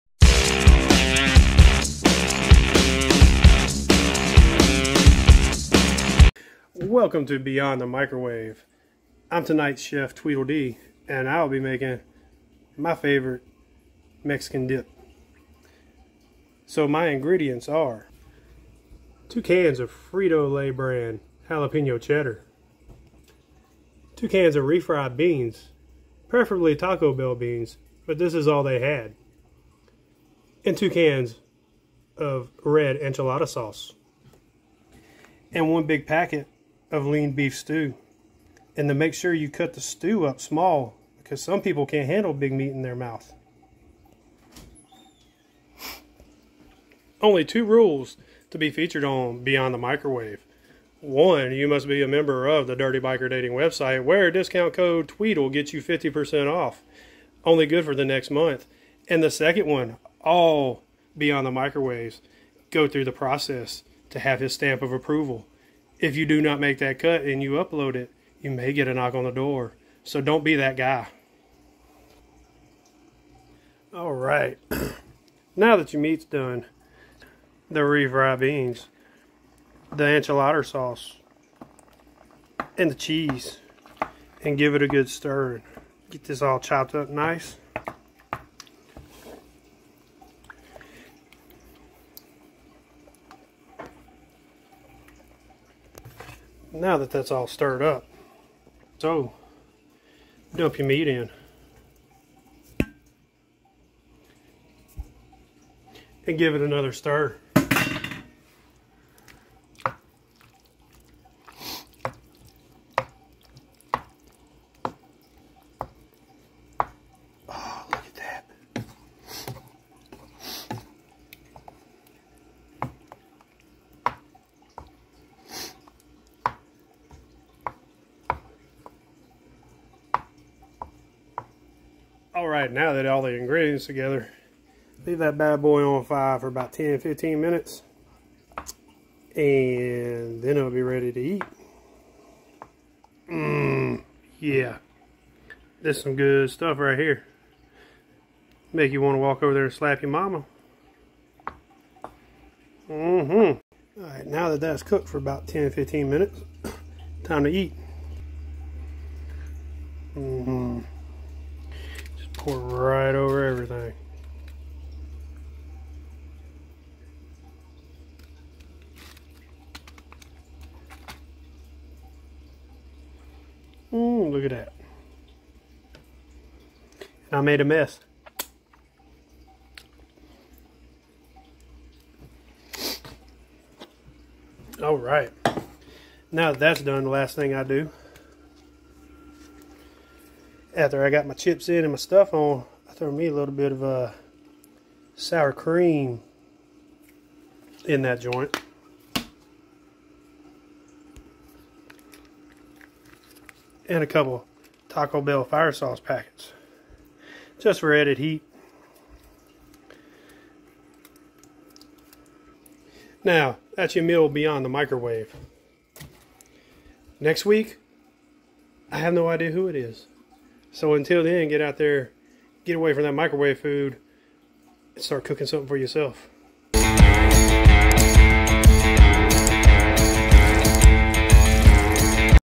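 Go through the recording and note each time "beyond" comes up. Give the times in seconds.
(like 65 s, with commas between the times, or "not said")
7 s, 49 s, 61 s, 214 s.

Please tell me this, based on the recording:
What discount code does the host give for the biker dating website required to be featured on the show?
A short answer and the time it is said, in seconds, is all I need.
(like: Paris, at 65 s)
TWEEDLE, at 55 s.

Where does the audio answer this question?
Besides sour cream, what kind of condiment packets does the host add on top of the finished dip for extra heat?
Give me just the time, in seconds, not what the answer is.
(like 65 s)
204 s.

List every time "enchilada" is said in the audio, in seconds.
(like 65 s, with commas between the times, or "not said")
32 s, 80 s.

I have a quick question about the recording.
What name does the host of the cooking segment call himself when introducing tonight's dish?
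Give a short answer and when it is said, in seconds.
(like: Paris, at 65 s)
Tweedledee, at 10 s.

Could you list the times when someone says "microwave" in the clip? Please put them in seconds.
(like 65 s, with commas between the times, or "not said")
7 s, 49 s, 61 s, 214 s, 223 s.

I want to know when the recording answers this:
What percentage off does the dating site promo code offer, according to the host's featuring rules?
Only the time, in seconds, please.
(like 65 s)
55 s.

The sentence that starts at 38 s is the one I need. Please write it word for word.
And to make sure you cut the stew up small because some people can't handle big meat in their mouth.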